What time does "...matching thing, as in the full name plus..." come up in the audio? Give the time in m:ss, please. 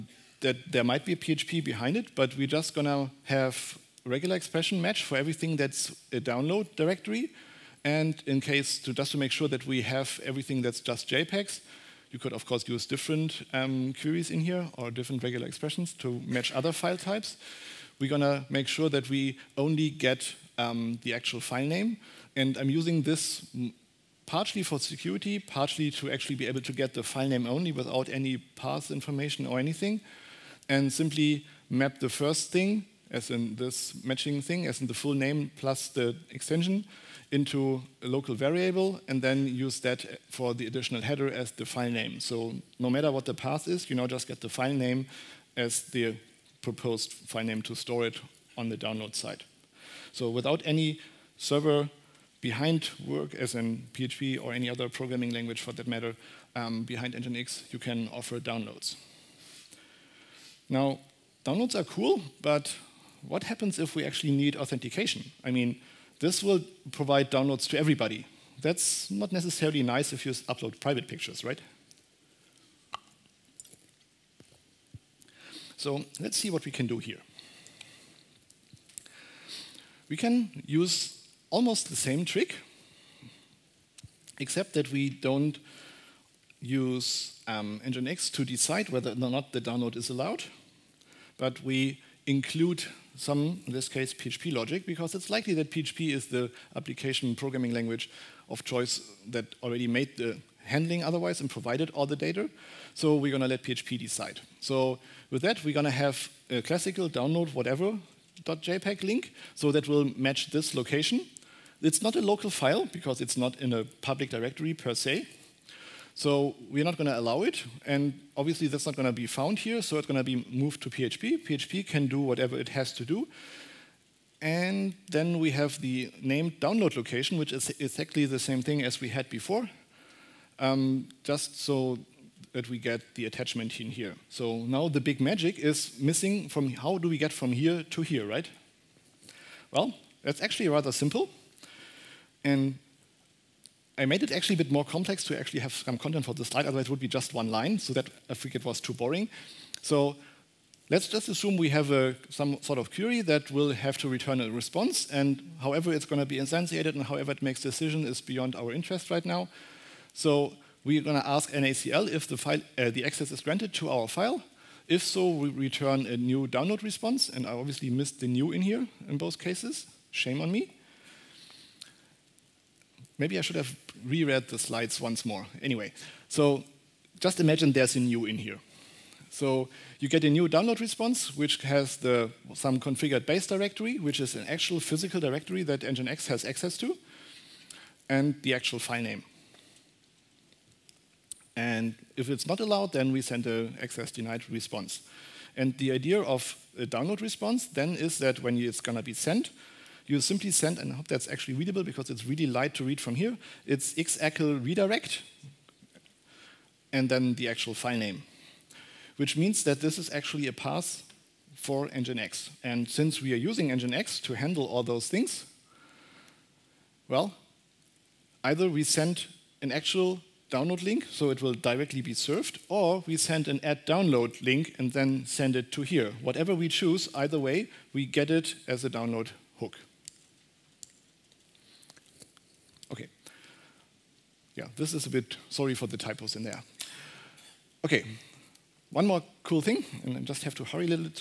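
0:34.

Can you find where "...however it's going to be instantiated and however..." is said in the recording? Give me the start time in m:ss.
2:35.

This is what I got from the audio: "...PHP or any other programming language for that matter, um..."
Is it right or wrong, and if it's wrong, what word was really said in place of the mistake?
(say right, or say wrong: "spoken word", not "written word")
right.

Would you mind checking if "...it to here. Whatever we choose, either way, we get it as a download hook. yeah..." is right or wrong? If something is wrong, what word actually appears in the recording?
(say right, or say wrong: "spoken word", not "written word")
right.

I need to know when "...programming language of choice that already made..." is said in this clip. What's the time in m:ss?
1:37.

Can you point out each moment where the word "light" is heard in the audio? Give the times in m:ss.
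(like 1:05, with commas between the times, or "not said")
3:22.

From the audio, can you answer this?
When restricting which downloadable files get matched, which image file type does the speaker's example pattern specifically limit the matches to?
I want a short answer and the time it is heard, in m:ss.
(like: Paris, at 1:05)
JPEGs, at 0:11.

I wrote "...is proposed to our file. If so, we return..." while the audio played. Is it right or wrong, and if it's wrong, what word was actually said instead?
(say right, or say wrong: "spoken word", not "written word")
wrong: "granted", not "proposed".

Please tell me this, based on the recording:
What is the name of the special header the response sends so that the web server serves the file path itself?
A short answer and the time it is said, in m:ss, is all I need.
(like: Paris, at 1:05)
X-Accel redirect, at 3:23.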